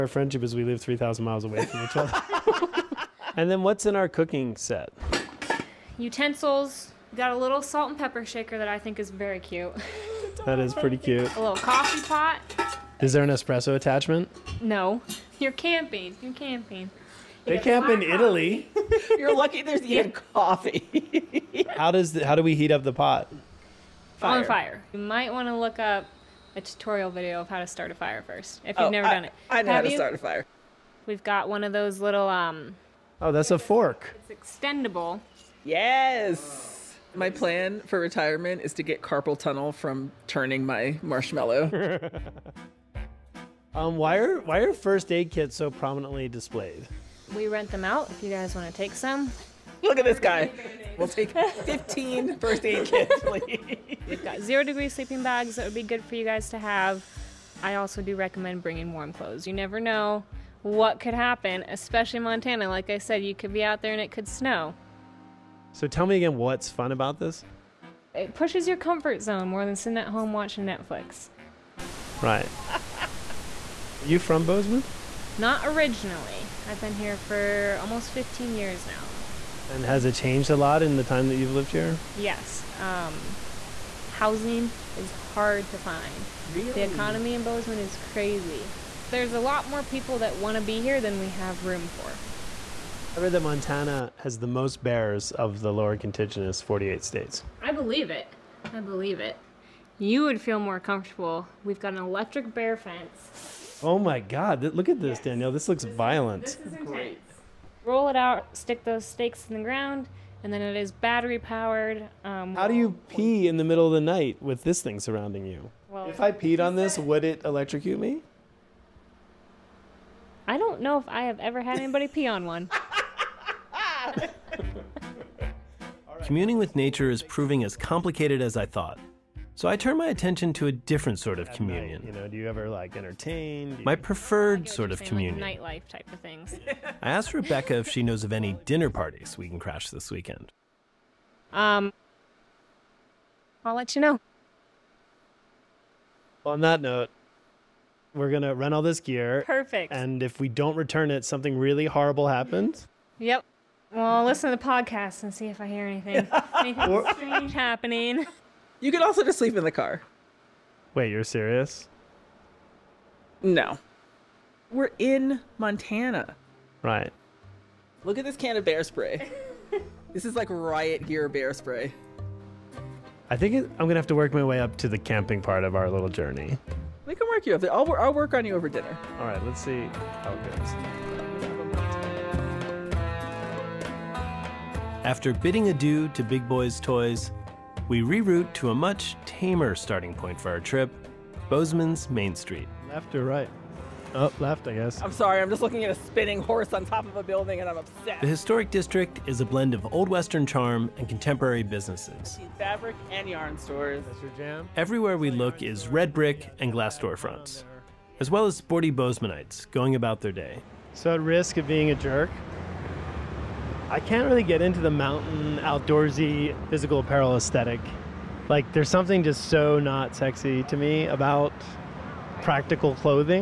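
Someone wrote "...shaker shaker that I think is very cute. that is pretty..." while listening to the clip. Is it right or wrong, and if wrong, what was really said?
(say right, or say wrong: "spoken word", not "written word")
wrong: "pepper", not "shaker".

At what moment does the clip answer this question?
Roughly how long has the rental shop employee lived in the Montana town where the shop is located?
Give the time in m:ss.
1:17.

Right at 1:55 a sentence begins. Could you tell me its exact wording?
Well, if I peed on this, would it electrocute me?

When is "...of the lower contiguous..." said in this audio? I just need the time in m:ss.
1:35.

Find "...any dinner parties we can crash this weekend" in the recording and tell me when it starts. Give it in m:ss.
2:18.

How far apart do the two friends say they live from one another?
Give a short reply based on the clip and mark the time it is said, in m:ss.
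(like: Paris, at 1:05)
3,000 miles, at 0:00.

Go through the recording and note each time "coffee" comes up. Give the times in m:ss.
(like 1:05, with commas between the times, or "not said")
0:11, 0:20.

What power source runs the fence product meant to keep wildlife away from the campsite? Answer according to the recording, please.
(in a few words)
battery.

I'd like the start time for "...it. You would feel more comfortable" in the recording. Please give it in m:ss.
1:39.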